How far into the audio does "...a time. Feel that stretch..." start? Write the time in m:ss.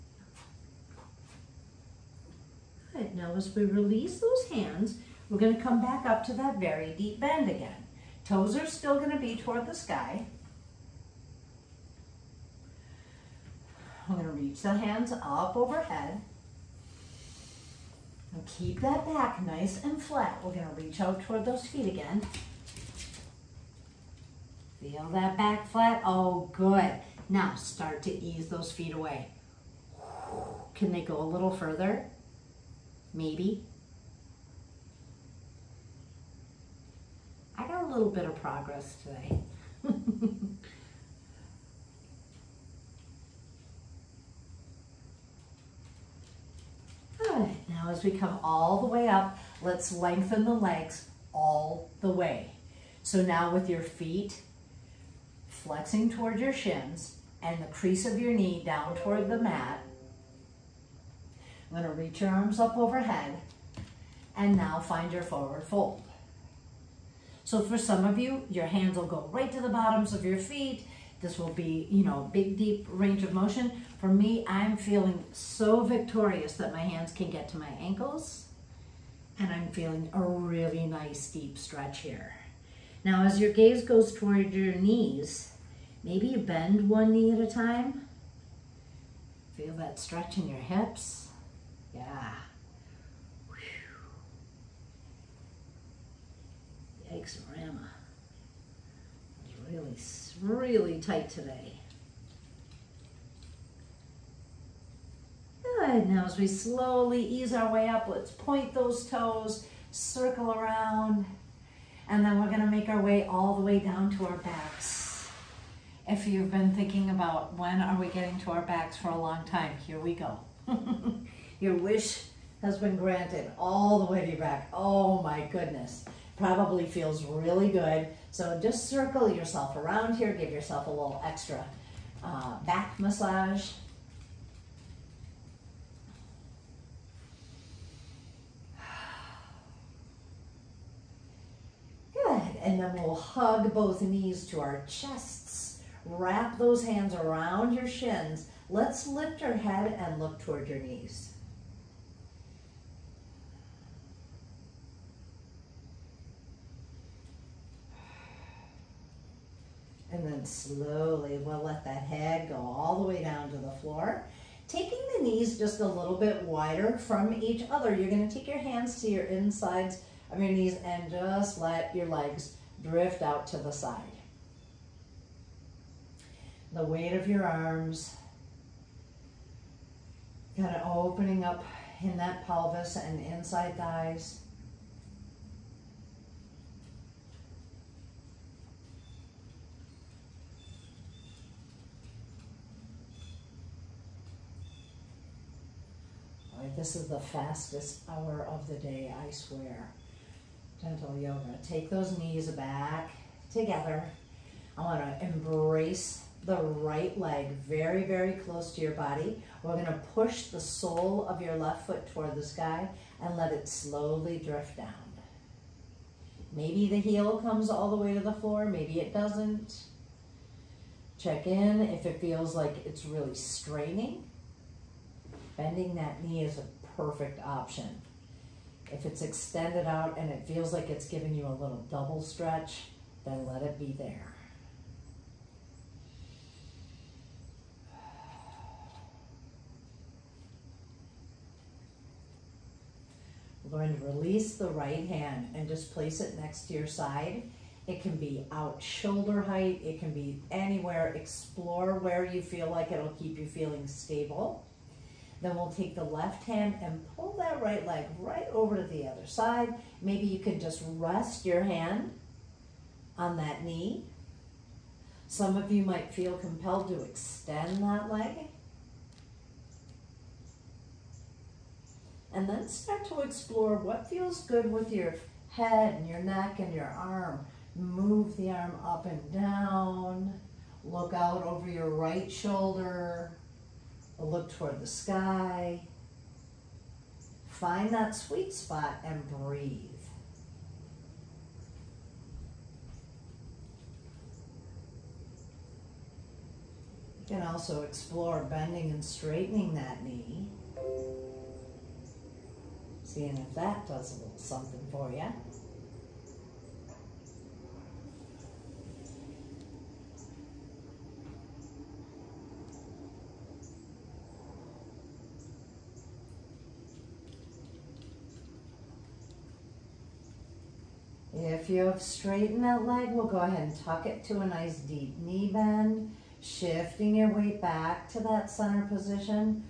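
1:27.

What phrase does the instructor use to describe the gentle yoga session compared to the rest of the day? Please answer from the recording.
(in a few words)
fastest hour.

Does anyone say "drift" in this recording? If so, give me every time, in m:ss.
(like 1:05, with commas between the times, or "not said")
2:52, 3:34.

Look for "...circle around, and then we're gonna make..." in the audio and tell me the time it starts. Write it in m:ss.
1:49.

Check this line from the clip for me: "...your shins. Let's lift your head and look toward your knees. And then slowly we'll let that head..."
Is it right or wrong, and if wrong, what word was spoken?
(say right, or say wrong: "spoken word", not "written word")
right.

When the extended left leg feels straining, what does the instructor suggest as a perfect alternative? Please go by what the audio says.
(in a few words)
Bending that knee.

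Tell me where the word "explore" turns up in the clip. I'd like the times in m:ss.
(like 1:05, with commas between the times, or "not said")
4:11, 4:33, 4:57.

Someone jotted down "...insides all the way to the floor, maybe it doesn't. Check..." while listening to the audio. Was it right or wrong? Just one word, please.
wrong.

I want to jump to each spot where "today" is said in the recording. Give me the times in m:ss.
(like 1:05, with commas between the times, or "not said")
0:39, 1:41.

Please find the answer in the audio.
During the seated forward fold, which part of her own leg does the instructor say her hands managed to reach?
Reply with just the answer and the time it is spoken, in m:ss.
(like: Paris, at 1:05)
ankles, at 1:17.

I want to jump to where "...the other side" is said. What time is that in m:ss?
4:18.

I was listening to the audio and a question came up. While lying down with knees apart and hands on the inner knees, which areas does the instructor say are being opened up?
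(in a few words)
pelvis and inside thighs.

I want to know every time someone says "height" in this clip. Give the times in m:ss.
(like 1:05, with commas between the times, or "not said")
4:09.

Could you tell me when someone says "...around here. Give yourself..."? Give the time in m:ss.
2:09.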